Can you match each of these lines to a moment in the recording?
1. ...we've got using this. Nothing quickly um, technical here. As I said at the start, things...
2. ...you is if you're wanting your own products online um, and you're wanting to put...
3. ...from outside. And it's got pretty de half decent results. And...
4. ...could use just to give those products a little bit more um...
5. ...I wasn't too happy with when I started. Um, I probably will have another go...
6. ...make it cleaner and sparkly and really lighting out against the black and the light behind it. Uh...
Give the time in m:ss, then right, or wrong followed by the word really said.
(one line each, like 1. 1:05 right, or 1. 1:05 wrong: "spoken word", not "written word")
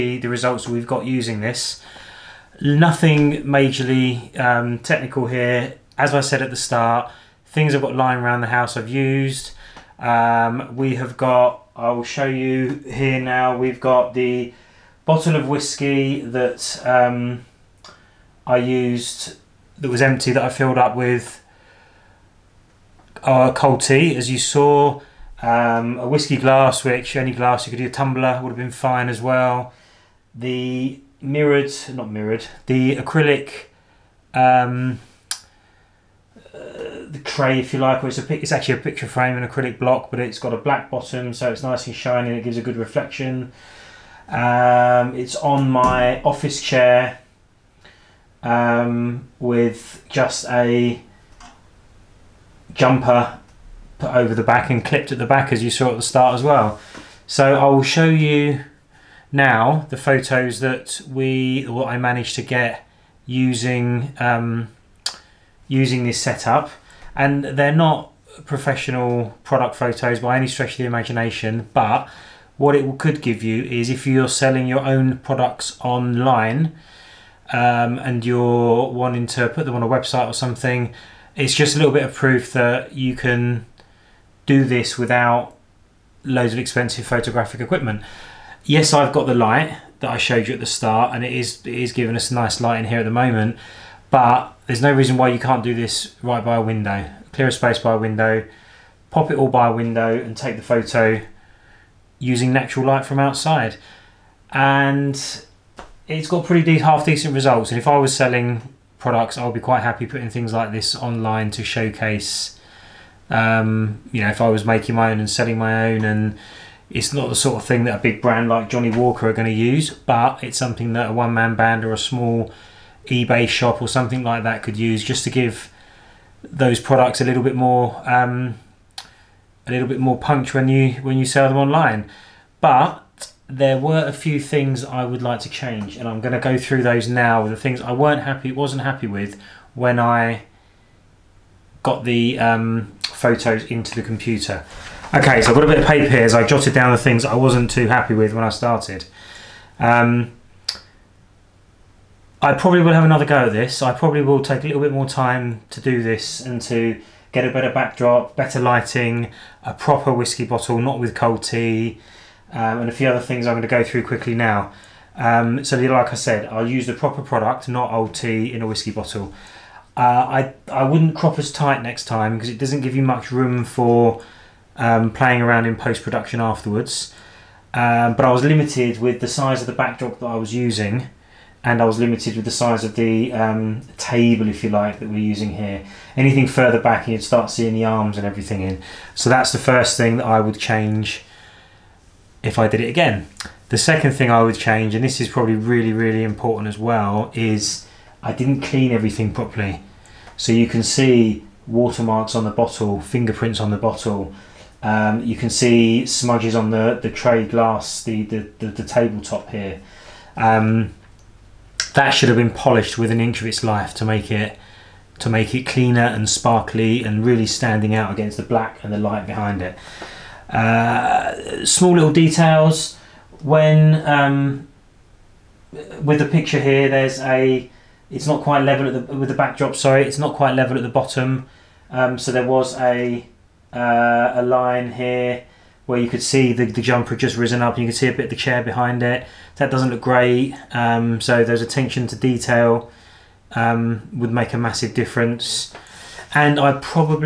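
1. 0:00 wrong: "majorly", not "quickly"
2. 1:13 wrong: "selling", not "wanting"
3. 1:43 right
4. 2:04 right
5. 2:27 right
6. 3:35 wrong: "standing", not "lighting".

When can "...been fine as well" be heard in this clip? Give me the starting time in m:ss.
0:28.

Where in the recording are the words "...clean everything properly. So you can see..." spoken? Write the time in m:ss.
3:18.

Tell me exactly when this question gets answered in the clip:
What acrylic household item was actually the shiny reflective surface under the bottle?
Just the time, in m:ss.
0:38.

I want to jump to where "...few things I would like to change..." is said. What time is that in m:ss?
2:14.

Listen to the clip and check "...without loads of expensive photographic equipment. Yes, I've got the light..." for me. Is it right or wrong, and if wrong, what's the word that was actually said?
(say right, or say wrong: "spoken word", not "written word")
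right.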